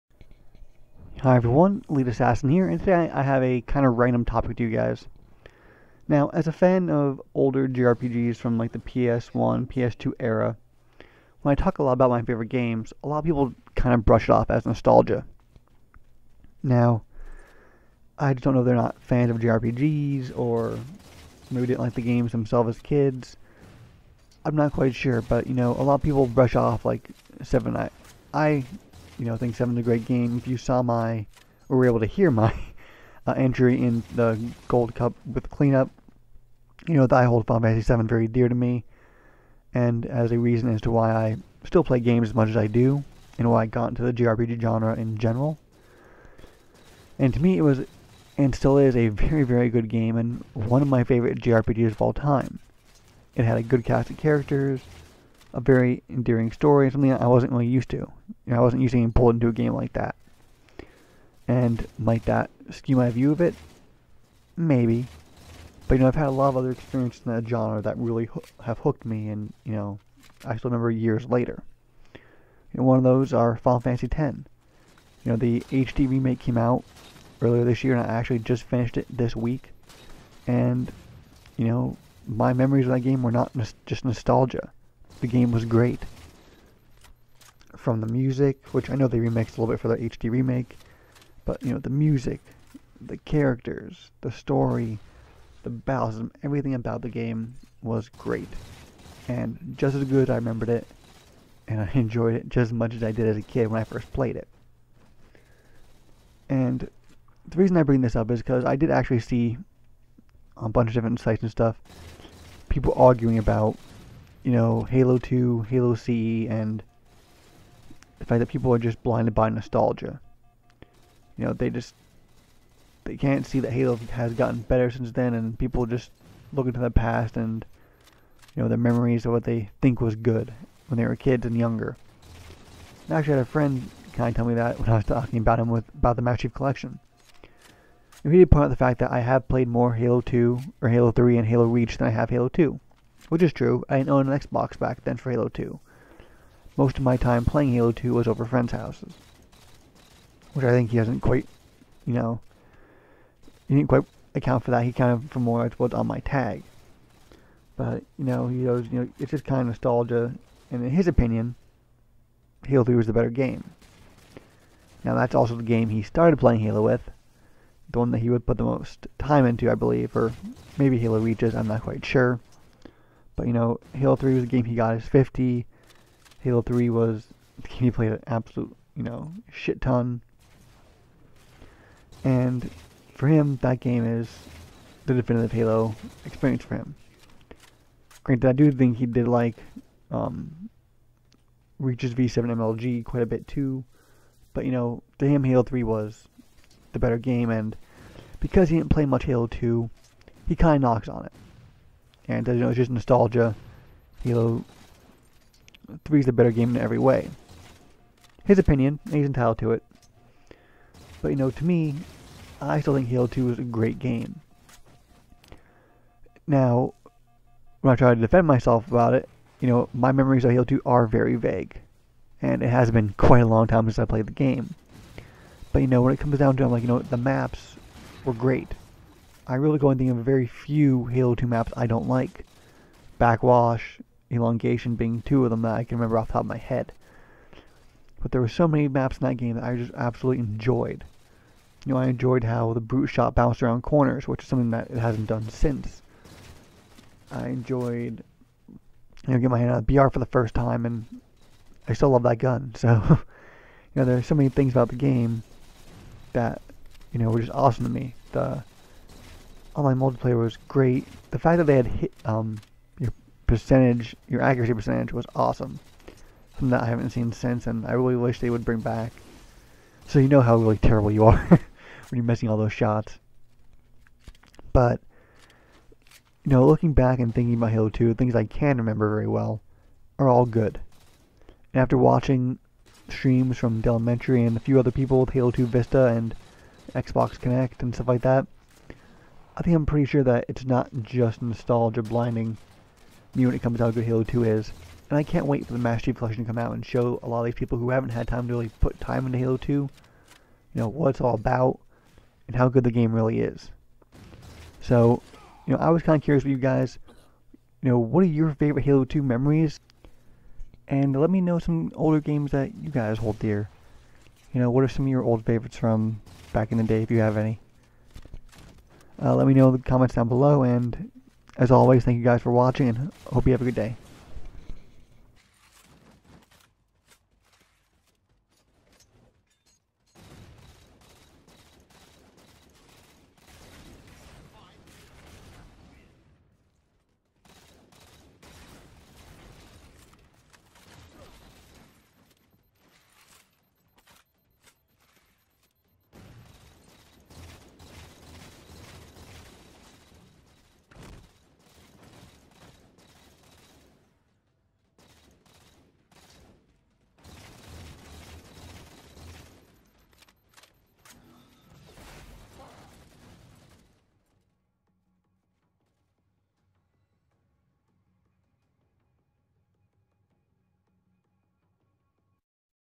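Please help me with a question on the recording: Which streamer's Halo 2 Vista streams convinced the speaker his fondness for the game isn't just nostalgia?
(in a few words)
Elementary.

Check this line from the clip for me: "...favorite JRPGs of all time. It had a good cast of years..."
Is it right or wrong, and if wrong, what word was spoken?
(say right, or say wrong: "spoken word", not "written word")
wrong: "characters", not "years".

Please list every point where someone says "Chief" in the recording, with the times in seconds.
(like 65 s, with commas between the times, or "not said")
136 s, 296 s.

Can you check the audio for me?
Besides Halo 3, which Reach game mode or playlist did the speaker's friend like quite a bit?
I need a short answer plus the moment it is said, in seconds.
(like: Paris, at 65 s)
V7 MLG, at 192 s.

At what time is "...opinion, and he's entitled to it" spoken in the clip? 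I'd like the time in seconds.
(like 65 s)
208 s.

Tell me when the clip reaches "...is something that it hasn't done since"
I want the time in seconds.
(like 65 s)
244 s.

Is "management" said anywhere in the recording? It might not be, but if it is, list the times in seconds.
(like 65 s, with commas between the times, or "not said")
not said.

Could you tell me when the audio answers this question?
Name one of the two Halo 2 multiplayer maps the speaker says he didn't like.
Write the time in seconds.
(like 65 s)
233 s.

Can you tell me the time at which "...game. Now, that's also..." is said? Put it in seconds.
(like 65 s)
163 s.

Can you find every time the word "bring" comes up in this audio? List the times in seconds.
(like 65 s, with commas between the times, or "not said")
107 s, 268 s.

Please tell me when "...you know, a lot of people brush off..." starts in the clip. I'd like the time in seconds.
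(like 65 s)
25 s.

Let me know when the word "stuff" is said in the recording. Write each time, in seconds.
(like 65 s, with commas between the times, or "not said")
111 s, 287 s.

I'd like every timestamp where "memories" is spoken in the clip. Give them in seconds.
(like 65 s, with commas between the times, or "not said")
82 s, 128 s, 220 s, 309 s.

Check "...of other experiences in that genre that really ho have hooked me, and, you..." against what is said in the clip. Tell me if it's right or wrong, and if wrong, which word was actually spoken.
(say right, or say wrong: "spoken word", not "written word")
right.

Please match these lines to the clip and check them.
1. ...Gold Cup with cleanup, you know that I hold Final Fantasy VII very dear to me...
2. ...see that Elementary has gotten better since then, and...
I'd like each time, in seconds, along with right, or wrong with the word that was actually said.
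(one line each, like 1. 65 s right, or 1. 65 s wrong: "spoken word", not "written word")
1. 34 s right
2. 123 s wrong: "Halo", not "Elementary".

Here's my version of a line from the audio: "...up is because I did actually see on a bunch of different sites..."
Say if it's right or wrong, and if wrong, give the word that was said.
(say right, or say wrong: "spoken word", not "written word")
right.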